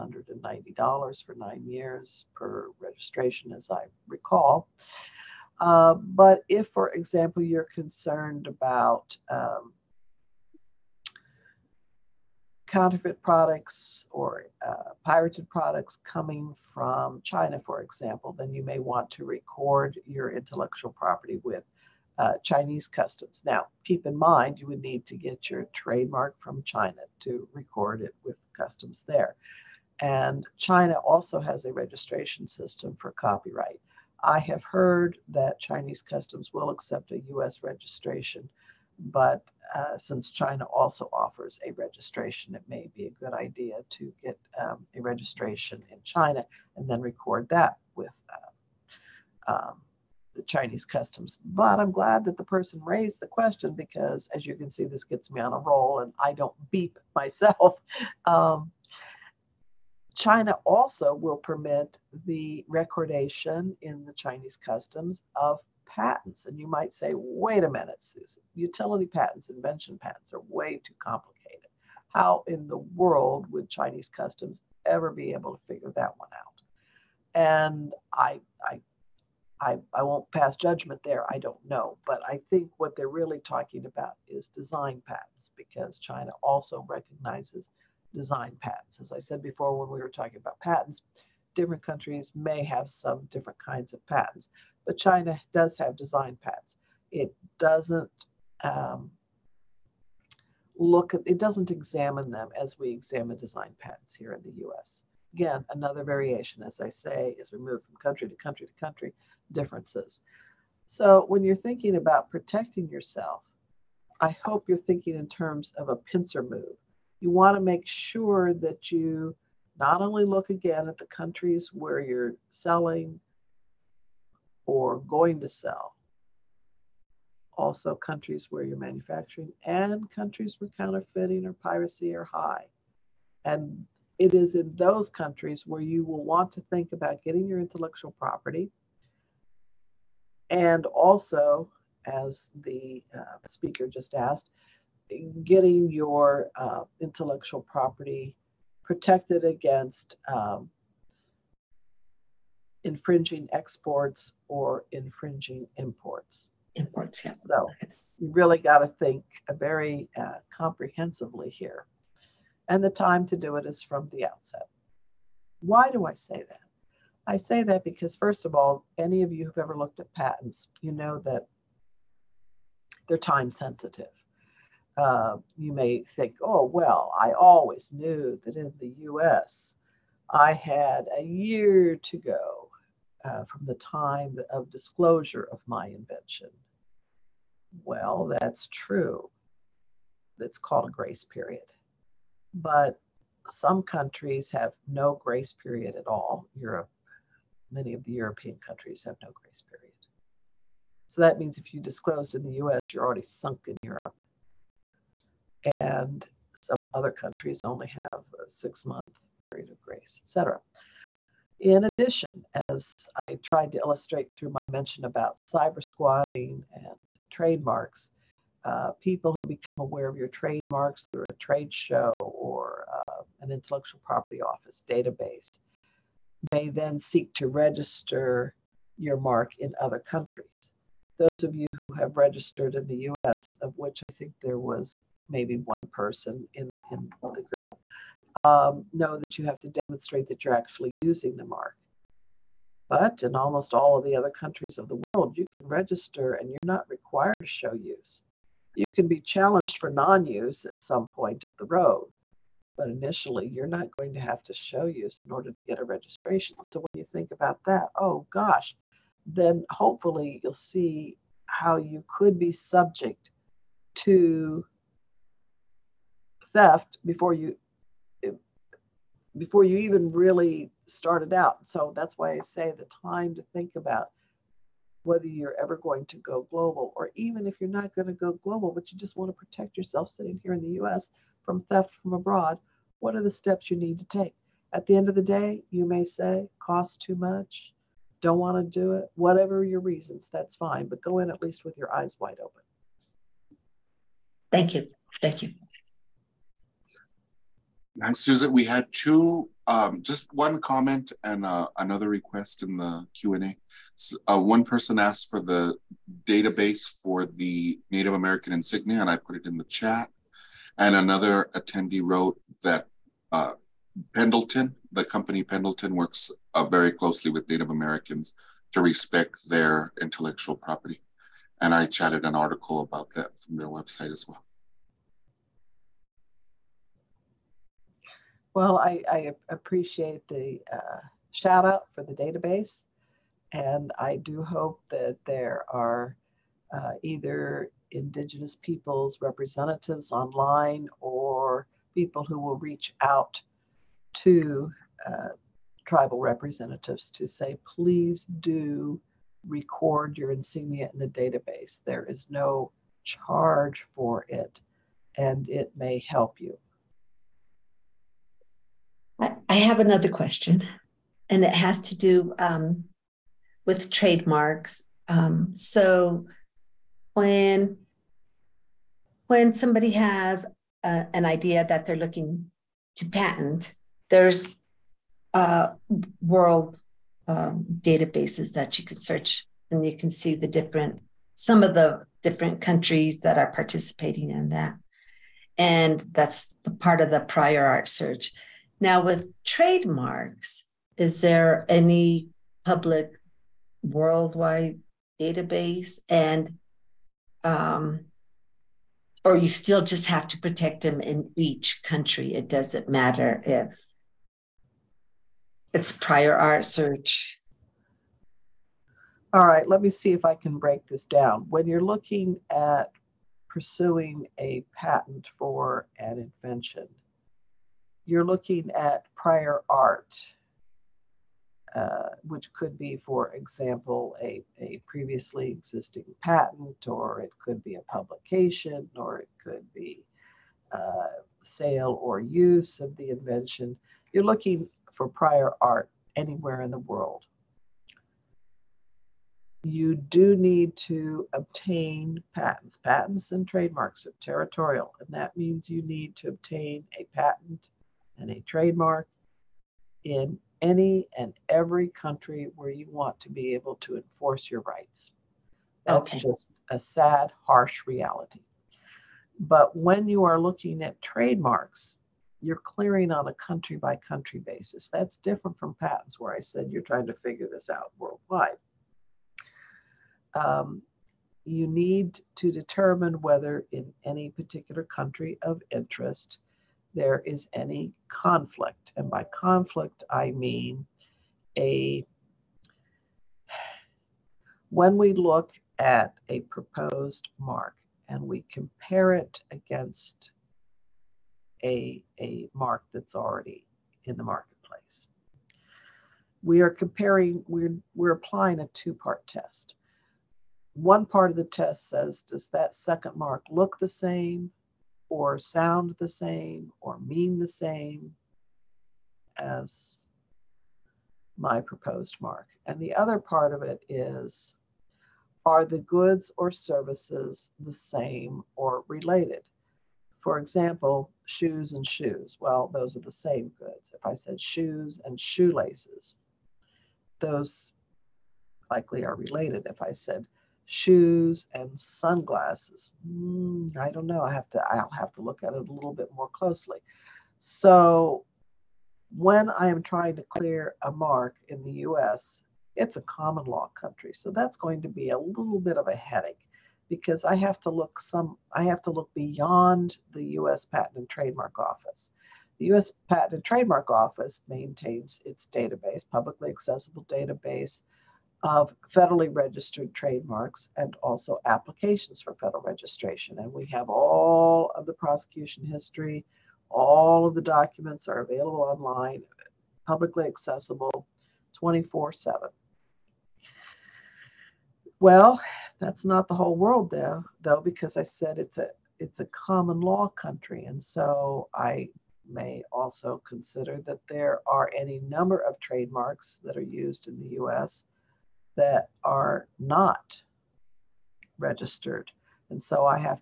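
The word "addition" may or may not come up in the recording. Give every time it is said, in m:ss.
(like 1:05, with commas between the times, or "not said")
3:31.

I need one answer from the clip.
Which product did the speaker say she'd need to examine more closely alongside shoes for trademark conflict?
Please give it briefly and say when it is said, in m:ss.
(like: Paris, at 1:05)
sunglasses, at 8:51.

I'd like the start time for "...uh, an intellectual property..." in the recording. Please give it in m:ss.
3:42.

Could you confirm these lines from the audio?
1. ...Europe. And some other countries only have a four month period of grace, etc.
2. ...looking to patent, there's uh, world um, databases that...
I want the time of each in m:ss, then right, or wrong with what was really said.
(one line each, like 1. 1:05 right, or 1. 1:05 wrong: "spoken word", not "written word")
1. 3:23 wrong: "six", not "four"
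2. 6:11 right.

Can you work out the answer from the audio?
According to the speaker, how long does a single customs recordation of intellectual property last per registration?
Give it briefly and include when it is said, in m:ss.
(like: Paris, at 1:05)
9 years, at 0:01.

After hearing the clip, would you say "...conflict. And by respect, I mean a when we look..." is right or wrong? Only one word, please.
wrong.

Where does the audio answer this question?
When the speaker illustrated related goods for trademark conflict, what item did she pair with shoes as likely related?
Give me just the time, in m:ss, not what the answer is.
8:45.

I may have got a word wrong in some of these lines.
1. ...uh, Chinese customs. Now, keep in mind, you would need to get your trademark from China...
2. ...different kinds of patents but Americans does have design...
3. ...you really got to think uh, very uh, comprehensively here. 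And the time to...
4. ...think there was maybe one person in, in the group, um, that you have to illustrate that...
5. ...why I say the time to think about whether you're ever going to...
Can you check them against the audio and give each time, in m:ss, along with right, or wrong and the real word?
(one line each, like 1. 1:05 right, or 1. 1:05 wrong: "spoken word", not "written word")
1. 0:22 right
2. 1:33 wrong: "China", not "Americans"
3. 2:38 right
4. 3:54 wrong: "demonstrate", not "illustrate"
5. 4:32 right.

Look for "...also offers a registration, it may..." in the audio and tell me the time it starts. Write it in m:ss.
0:40.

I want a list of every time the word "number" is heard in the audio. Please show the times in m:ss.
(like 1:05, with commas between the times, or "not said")
9:45.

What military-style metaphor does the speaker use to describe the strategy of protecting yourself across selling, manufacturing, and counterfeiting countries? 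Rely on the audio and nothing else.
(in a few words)
pincer move.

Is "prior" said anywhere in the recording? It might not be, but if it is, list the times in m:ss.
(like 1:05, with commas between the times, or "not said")
6:27, 6:45, 6:59, 7:15.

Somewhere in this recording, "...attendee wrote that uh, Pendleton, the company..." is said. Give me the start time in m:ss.
5:11.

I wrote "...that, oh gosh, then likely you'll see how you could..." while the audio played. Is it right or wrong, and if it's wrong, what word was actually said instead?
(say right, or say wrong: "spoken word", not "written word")
wrong: "hopefully", not "likely".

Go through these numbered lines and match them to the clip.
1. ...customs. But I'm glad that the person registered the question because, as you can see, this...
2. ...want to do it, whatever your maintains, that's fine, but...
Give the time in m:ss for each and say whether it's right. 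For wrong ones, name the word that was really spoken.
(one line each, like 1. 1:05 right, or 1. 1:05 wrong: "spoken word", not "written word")
1. 0:50 wrong: "raised", not "registered"
2. 4:48 wrong: "reasons", not "maintains".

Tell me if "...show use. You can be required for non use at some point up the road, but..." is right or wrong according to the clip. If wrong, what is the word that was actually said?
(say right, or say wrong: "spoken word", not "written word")
wrong: "challenged", not "required".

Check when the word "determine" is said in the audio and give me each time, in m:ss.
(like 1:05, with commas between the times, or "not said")
7:52.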